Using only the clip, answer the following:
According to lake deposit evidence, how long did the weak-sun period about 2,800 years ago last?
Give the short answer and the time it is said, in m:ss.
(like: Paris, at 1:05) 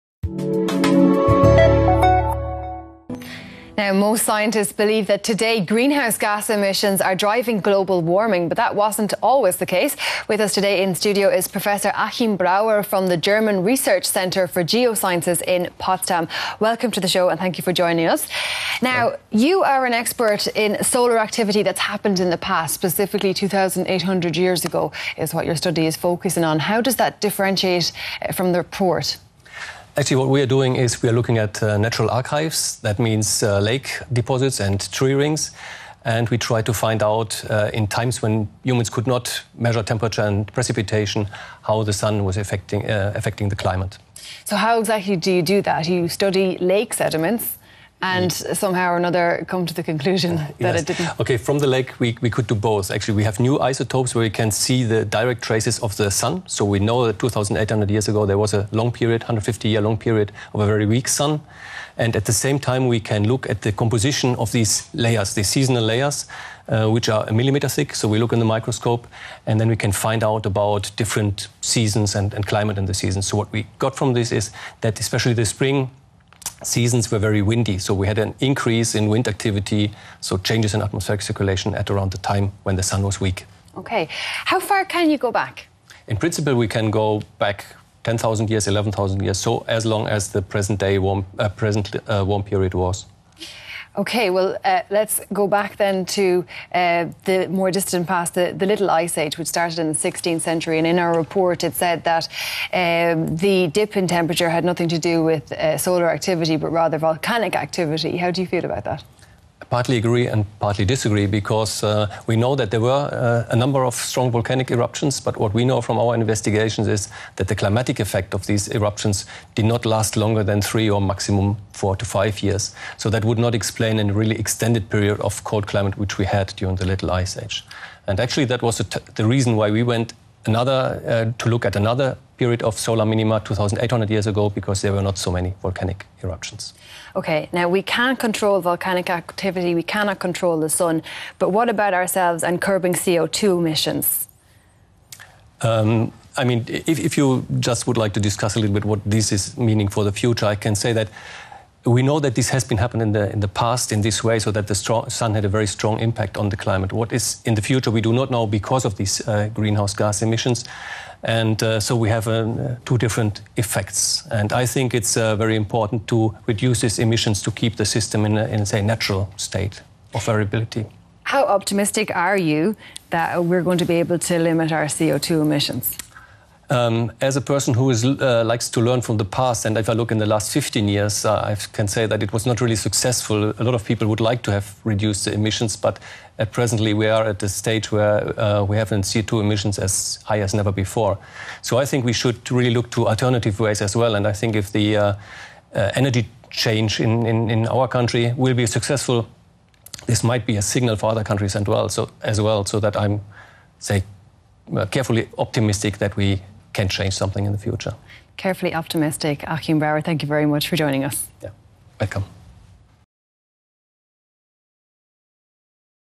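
150 years, at 0:59.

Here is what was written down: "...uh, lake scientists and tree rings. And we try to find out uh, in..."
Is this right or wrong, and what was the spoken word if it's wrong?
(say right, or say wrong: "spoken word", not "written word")
wrong: "deposits", not "scientists".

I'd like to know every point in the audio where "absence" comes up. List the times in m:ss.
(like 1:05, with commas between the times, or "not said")
not said.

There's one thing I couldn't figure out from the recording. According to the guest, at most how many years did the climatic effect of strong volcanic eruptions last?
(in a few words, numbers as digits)
4 to 5 years.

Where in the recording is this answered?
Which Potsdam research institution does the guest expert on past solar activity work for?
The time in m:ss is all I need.
0:13.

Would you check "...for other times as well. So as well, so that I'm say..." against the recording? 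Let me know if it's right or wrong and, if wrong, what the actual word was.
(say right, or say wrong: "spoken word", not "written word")
wrong: "countries", not "times".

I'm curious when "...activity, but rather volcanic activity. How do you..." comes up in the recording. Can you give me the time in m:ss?
1:46.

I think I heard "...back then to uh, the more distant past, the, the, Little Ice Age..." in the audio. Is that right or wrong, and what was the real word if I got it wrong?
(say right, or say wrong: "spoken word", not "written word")
right.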